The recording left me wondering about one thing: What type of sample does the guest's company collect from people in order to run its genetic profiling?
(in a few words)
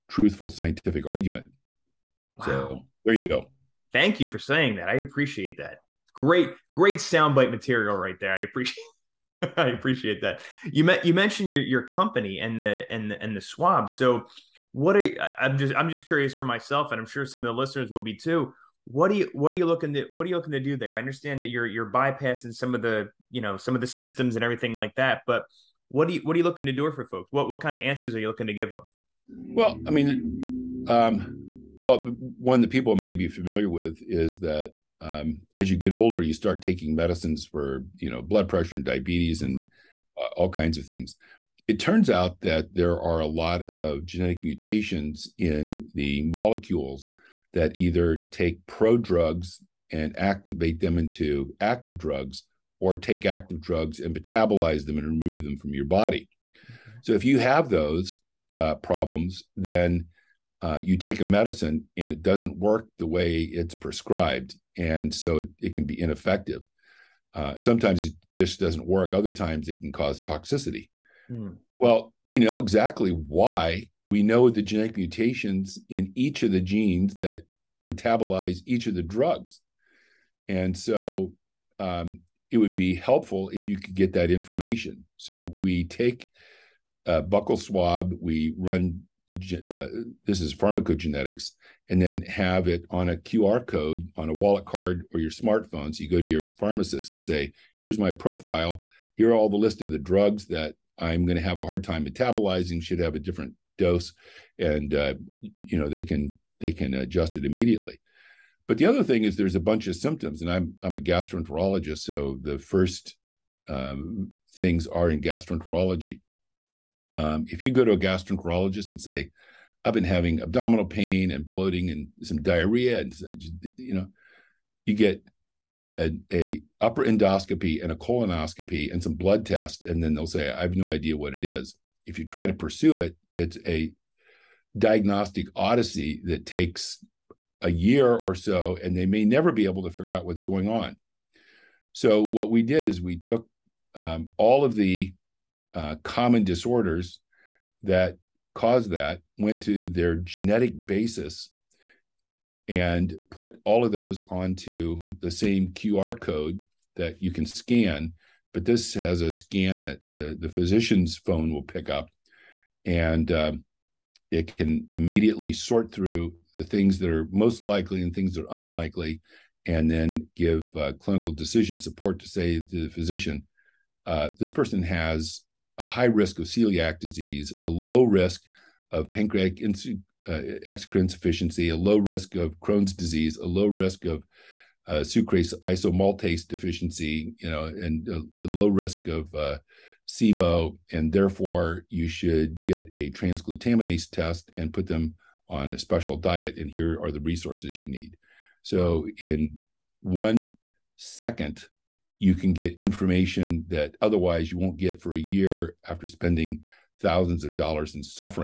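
Buccal swab.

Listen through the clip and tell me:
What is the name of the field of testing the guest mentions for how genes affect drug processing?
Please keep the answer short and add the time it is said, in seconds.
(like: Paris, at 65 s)
Pharmacogenetics, at 90 s.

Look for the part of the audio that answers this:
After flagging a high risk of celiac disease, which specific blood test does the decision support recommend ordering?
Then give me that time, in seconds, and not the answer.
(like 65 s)
193 s.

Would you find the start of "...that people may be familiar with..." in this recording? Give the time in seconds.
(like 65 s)
32 s.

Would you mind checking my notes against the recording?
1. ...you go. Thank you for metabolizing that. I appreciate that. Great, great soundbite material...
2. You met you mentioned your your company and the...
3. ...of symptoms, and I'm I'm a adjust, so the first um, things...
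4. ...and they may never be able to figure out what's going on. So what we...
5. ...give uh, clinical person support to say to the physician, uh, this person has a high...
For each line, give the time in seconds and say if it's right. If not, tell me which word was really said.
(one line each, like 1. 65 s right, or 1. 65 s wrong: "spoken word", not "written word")
1. 3 s wrong: "saying", not "metabolizing"
2. 10 s right
3. 109 s wrong: "gastroenterologist", not "adjust"
4. 138 s right
5. 170 s wrong: "decision", not "person".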